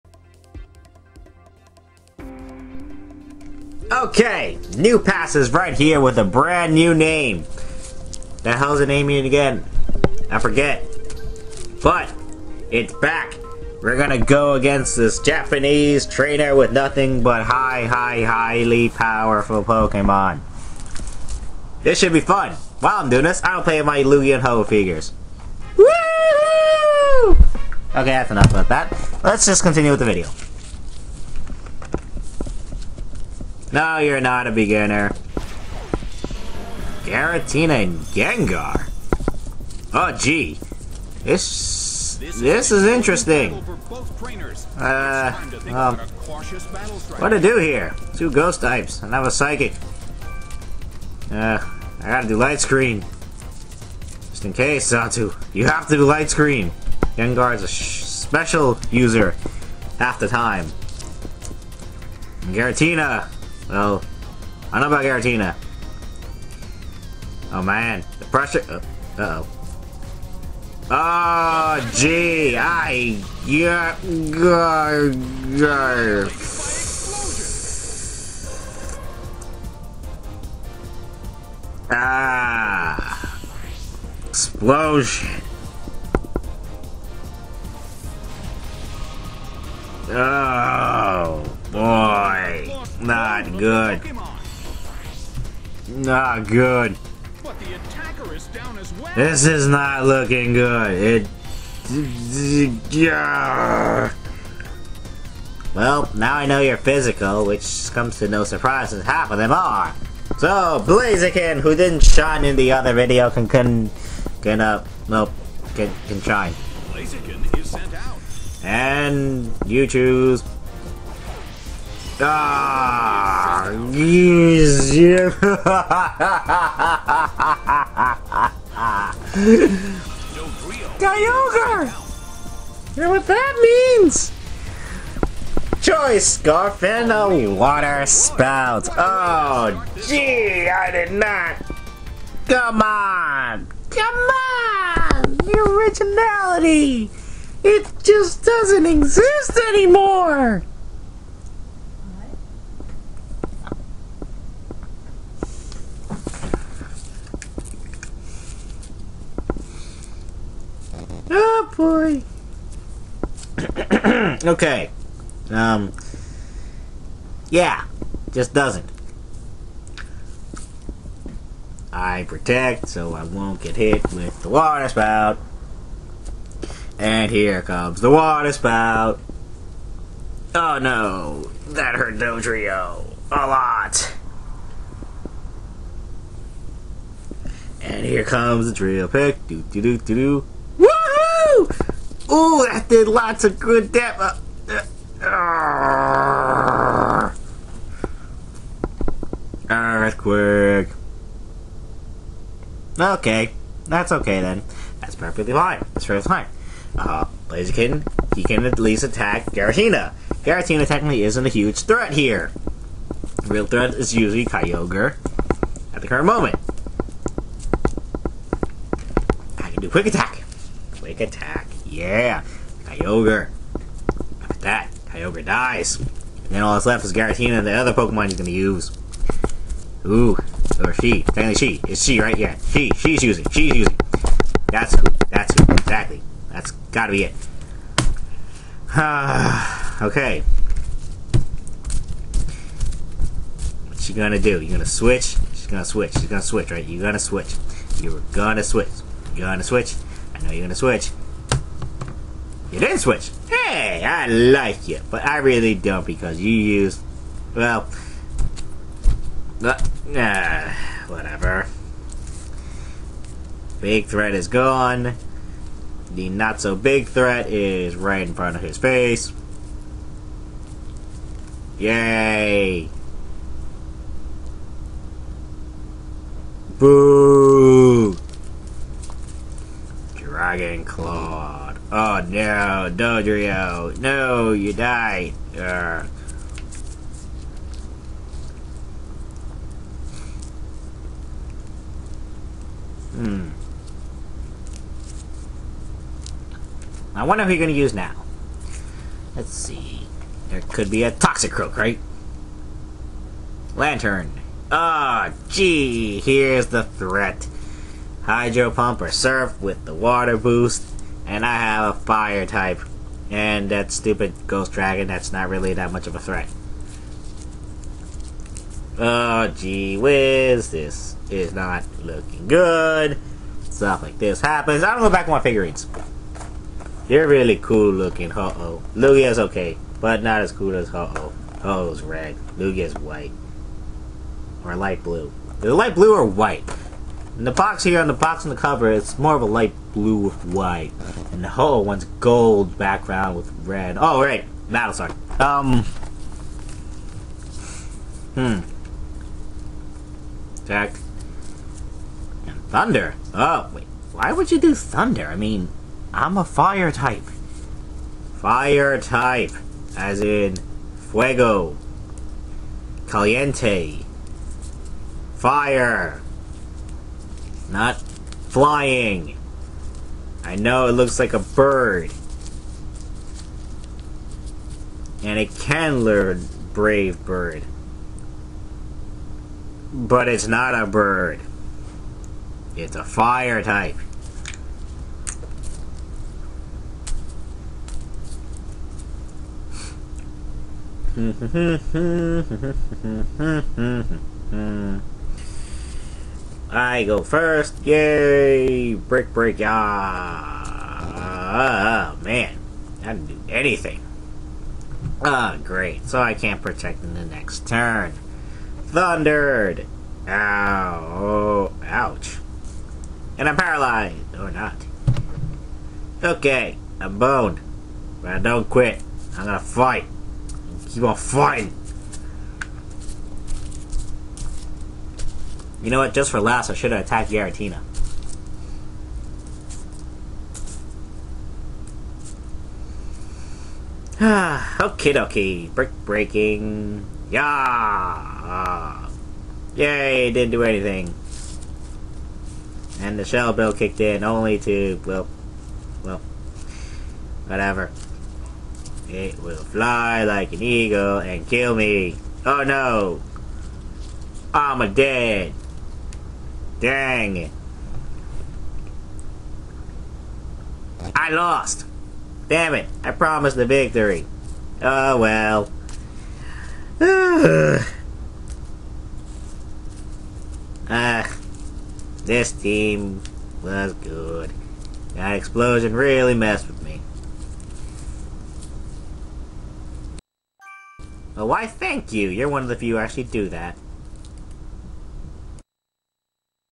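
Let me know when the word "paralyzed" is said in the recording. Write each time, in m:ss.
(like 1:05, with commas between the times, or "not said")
6:53.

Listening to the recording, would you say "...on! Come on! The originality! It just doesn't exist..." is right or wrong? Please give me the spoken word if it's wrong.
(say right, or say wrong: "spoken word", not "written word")
right.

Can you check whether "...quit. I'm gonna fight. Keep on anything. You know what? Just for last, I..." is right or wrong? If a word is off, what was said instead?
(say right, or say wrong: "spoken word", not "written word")
wrong: "fighting", not "anything".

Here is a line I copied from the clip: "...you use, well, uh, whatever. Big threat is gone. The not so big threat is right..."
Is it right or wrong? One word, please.
right.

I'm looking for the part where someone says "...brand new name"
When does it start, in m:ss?
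0:06.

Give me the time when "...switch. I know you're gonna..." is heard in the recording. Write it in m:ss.
4:09.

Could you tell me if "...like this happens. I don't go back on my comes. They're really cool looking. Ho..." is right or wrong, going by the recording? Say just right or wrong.
wrong.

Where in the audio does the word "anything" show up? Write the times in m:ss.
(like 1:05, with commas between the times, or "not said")
6:43, 7:20.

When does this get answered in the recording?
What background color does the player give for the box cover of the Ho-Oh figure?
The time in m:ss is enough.
5:42.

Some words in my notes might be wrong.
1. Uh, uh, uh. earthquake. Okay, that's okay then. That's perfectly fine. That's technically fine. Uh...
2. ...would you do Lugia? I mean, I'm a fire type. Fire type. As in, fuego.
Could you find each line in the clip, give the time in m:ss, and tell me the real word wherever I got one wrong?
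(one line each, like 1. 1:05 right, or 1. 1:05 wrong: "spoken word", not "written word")
1. 3:15 wrong: "perfectly", not "technically"
2. 5:54 wrong: "Thunder", not "Lugia".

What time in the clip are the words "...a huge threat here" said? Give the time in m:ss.
3:31.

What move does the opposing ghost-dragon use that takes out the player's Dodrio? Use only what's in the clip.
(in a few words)
Dragon Claw.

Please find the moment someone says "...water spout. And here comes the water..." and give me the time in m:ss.
2:54.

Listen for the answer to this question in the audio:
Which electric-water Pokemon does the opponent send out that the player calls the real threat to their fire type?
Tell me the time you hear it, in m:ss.
5:03.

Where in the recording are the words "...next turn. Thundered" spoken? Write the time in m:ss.
6:47.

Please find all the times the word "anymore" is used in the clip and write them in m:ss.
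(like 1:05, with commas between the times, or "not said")
2:29.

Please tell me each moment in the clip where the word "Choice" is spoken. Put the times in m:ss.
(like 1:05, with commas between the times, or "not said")
2:15.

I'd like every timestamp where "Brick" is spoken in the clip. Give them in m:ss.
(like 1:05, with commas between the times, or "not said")
6:38, 7:15.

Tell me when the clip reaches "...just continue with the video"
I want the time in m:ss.
0:29.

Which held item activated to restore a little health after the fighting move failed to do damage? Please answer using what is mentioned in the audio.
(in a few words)
Shell Bell.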